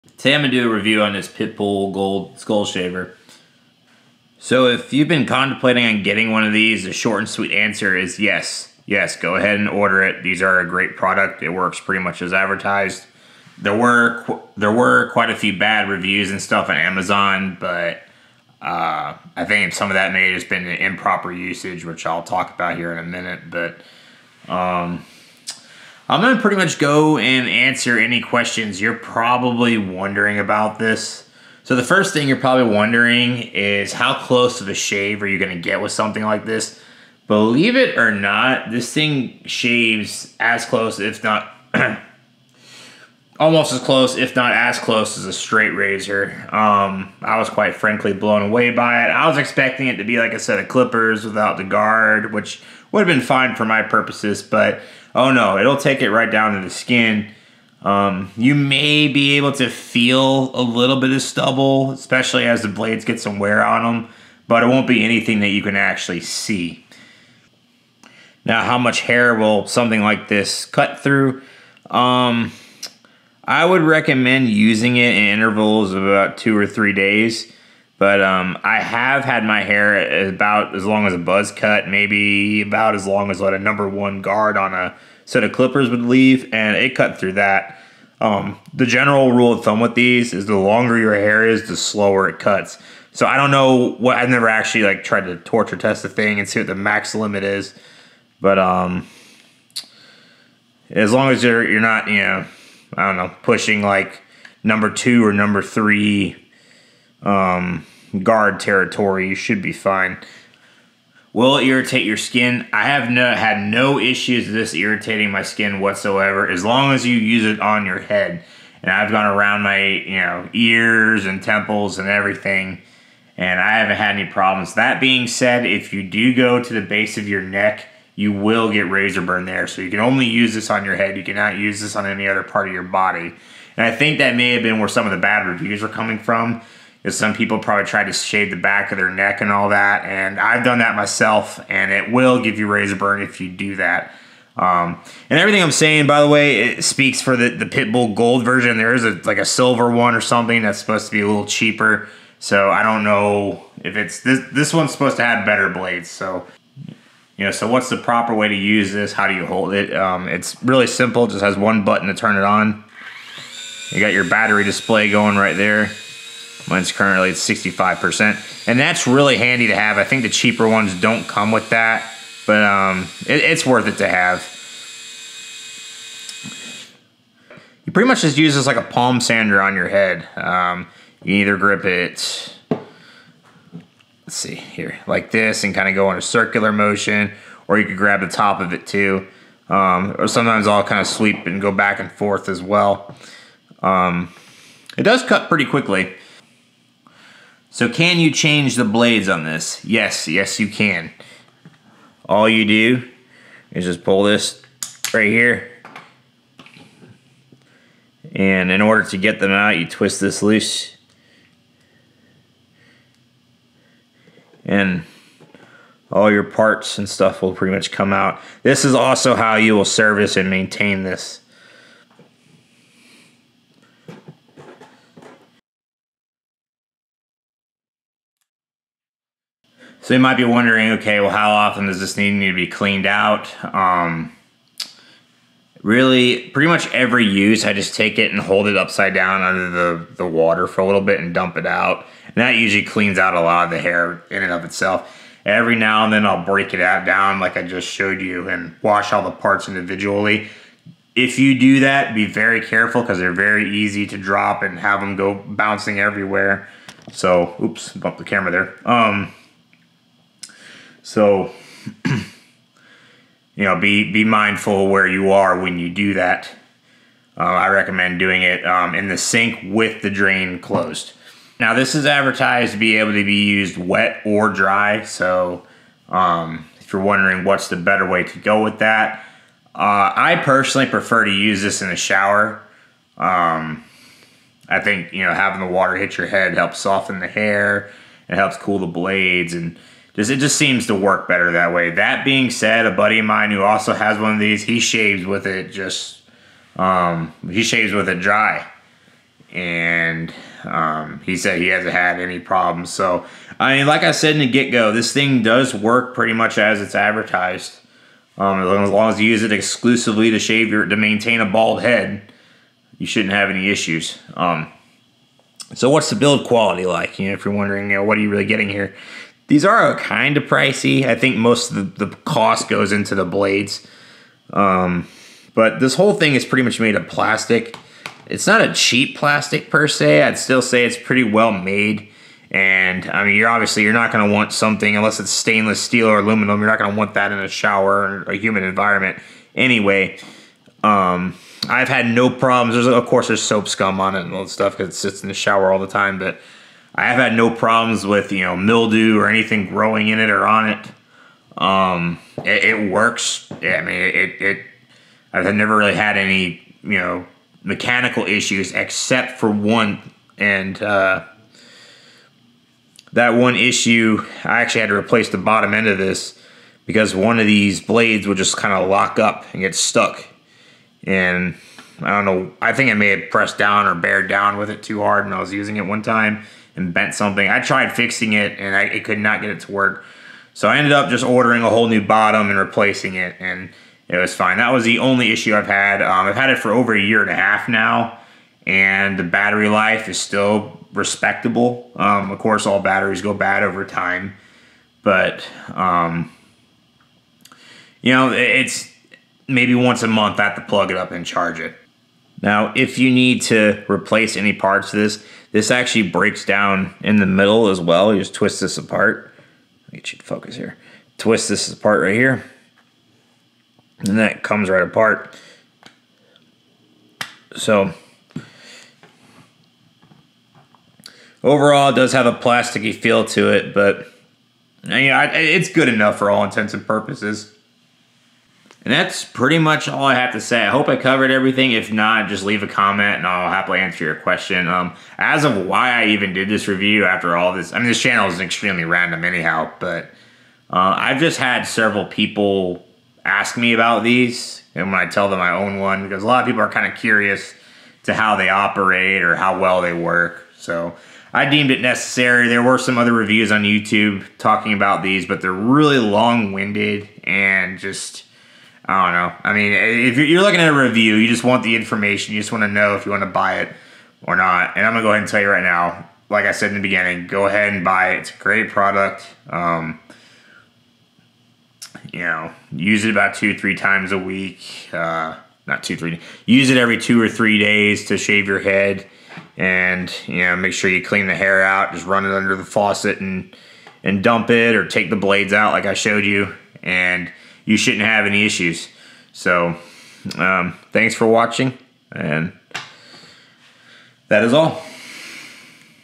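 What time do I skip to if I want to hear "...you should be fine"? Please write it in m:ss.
1:49.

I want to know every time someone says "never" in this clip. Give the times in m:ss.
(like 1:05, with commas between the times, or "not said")
1:34, 5:55.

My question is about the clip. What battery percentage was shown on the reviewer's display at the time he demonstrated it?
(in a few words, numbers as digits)
65%.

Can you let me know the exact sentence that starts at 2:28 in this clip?
There is a, like a silver one or something that's supposed to be a little cheaper.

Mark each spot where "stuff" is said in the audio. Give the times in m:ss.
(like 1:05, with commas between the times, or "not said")
0:16, 3:37, 5:44.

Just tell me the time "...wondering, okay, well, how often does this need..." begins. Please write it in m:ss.
3:50.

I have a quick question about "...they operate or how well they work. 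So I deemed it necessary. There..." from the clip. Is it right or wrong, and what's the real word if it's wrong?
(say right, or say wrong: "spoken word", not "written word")
right.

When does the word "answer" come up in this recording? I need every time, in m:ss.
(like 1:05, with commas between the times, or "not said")
0:07, 0:27, 7:13.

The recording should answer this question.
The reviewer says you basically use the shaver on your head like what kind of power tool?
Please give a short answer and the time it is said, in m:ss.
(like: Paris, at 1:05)
palm sander, at 2:58.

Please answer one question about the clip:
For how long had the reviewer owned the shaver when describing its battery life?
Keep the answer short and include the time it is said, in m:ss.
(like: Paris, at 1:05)
over a year and a half, at 6:26.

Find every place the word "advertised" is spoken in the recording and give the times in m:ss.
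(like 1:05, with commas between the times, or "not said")
0:12, 4:32, 5:06.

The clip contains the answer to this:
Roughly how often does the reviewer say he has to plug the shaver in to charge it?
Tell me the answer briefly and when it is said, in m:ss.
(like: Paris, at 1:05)
once a month, at 6:39.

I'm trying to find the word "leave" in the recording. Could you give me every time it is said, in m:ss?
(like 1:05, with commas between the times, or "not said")
1:26, 7:12.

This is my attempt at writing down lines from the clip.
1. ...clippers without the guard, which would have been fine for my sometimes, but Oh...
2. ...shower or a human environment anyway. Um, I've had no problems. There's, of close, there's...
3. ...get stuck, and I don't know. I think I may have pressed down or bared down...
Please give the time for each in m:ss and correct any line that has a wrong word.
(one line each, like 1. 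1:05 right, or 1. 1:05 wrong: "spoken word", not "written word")
1. 0:50 wrong: "purposes", not "sometimes"
2. 5:37 wrong: "course", not "close"
3. 6:09 right.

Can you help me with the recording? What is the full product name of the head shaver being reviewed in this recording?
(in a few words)
Pitbull Gold Skull Shaver.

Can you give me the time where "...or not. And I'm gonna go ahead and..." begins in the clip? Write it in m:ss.
7:44.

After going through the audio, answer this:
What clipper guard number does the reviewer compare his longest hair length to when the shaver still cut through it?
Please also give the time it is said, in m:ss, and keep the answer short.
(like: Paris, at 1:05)
1, at 1:23.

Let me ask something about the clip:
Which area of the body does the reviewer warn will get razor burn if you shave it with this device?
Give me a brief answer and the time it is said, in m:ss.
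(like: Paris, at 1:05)
base of your neck, at 2:06.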